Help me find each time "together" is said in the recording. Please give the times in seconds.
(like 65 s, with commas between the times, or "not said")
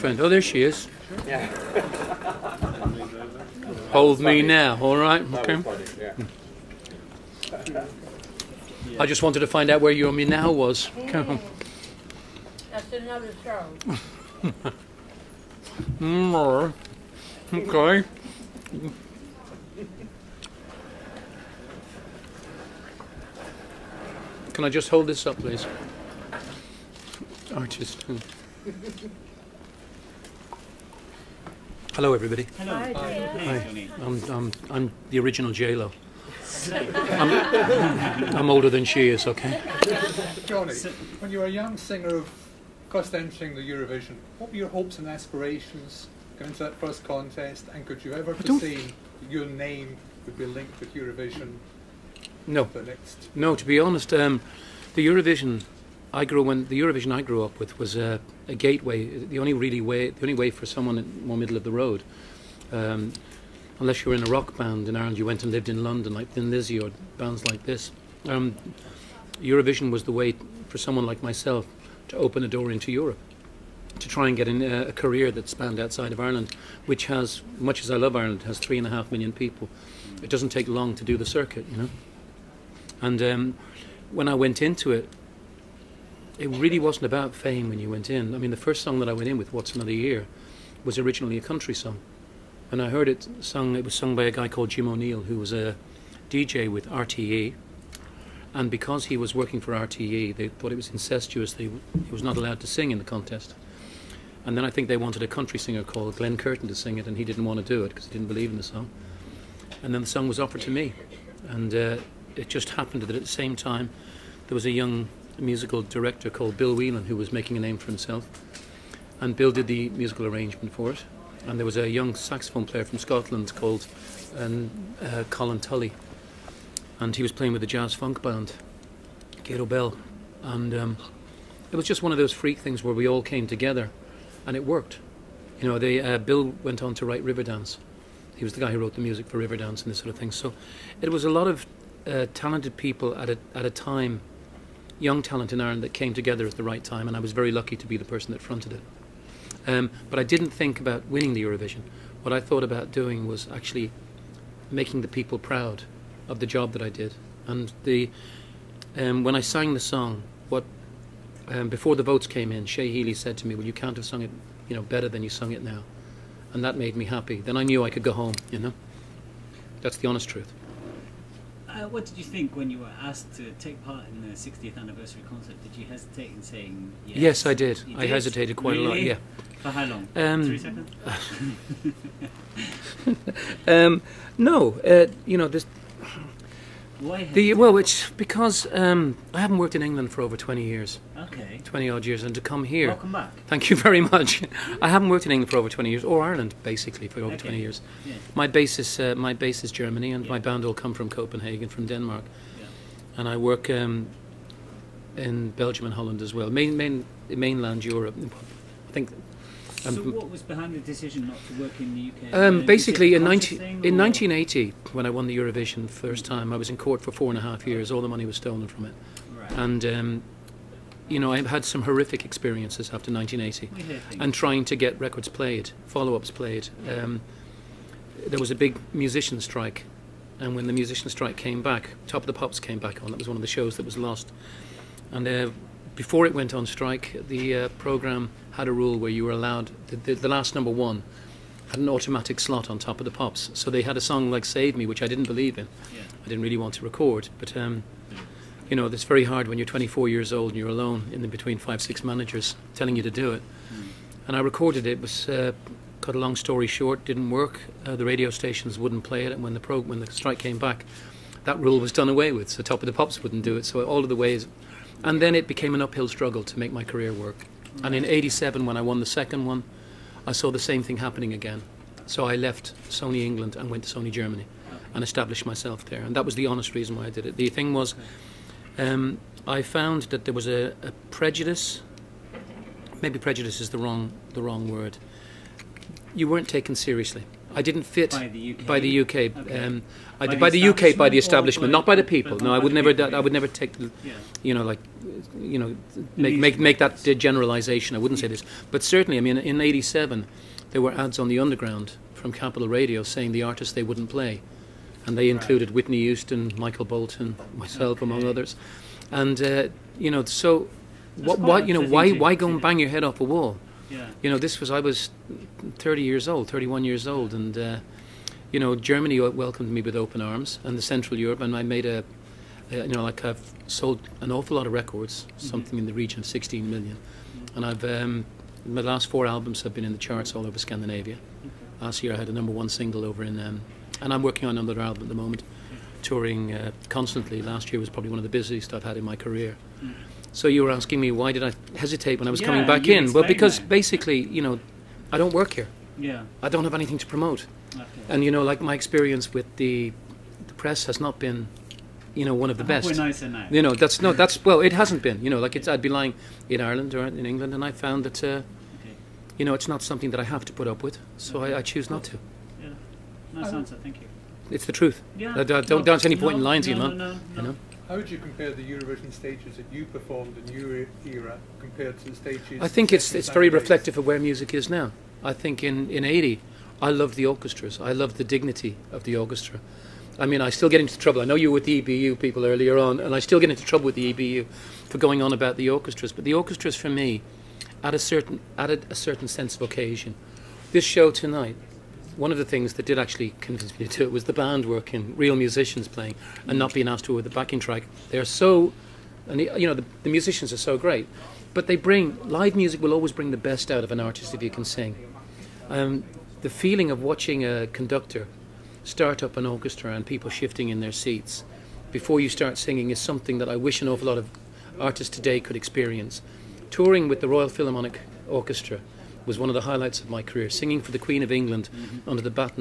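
133 s, 146 s.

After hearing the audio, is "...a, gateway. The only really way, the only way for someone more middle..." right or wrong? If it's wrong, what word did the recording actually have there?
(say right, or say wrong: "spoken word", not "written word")
right.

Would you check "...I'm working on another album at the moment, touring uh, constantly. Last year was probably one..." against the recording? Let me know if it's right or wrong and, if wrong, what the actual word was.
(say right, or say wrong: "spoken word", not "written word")
right.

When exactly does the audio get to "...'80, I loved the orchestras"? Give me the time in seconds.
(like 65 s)
376 s.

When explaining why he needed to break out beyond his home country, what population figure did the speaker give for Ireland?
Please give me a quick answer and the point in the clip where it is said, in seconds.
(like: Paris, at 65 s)
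3.5 million, at 78 s.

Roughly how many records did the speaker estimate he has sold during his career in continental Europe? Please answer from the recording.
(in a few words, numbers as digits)
16 million.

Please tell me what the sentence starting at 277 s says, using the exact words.
The thing was, um, I found that there was a, a, prejudice.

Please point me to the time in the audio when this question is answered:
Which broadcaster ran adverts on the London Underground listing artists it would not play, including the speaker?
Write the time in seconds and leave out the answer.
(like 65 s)
302 s.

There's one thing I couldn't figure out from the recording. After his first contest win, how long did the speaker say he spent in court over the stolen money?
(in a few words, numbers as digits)
4.5 years.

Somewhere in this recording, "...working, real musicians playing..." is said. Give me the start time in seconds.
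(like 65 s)
394 s.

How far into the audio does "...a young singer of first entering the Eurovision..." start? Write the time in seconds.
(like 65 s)
41 s.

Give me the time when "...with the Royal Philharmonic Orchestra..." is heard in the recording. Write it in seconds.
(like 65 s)
417 s.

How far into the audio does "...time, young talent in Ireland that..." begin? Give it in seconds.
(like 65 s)
143 s.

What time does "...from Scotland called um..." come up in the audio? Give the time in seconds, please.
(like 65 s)
122 s.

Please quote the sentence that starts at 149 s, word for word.
Um, but I didn't think about winning the Eurovision.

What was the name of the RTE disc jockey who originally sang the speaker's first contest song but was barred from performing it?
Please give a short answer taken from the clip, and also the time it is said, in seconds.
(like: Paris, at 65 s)
Jim O'Neill, at 94 s.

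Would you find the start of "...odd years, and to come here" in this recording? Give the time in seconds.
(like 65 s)
191 s.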